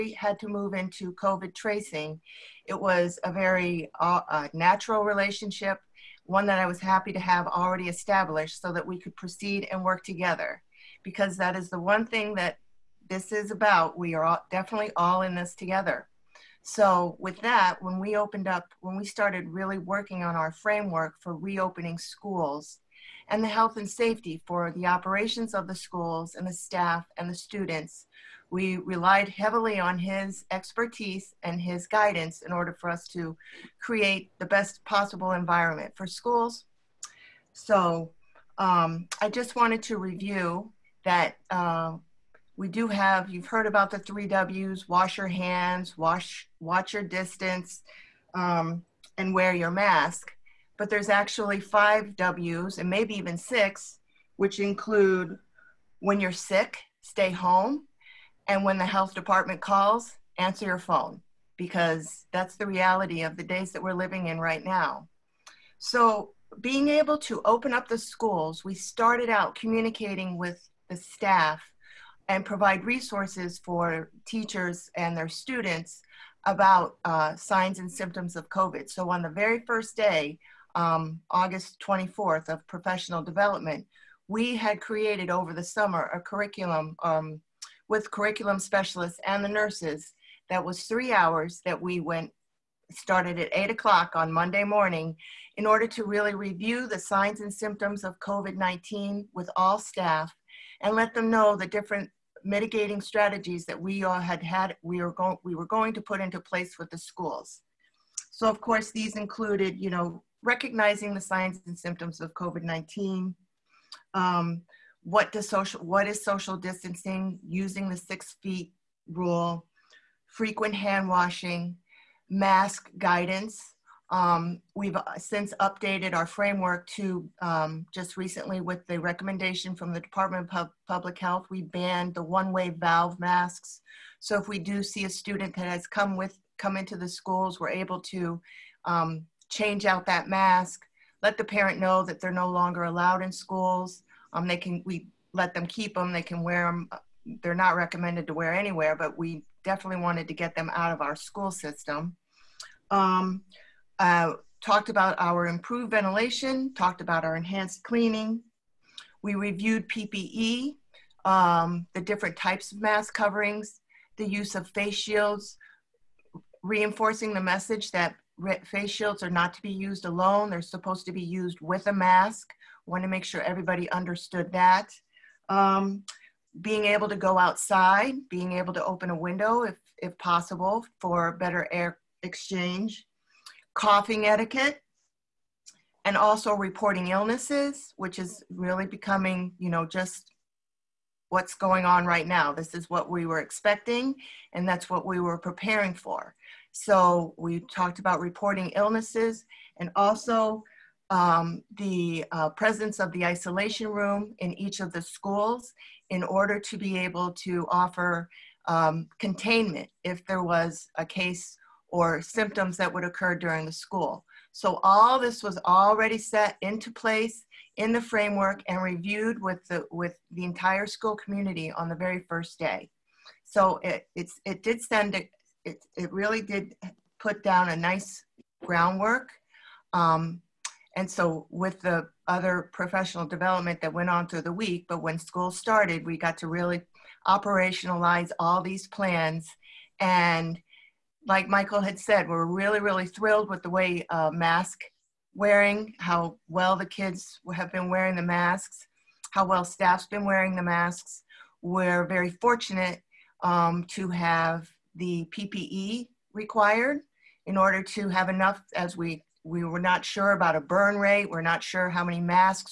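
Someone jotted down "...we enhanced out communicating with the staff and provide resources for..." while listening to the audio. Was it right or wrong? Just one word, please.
wrong.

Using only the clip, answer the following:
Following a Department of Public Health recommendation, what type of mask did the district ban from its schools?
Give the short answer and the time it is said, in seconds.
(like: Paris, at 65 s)
one-way valve masks, at 132 s.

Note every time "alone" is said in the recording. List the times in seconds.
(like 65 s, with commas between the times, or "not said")
170 s.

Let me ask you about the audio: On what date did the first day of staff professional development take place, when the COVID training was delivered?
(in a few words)
August 24th.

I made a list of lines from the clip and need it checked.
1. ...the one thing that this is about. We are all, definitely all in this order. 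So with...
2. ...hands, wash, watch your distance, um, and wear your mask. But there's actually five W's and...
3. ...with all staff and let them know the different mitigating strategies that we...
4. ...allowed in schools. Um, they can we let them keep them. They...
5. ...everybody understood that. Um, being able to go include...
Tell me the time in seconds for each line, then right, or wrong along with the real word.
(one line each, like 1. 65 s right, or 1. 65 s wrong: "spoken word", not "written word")
1. 11 s wrong: "together", not "order"
2. 45 s right
3. 99 s right
4. 142 s right
5. 173 s wrong: "outside", not "include".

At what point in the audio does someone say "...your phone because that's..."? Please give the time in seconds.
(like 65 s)
60 s.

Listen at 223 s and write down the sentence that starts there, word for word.
So it, it's, it did send, it, it, it really did put down a nice groundwork.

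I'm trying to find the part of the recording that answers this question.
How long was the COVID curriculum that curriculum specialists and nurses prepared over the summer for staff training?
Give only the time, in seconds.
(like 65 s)
90 s.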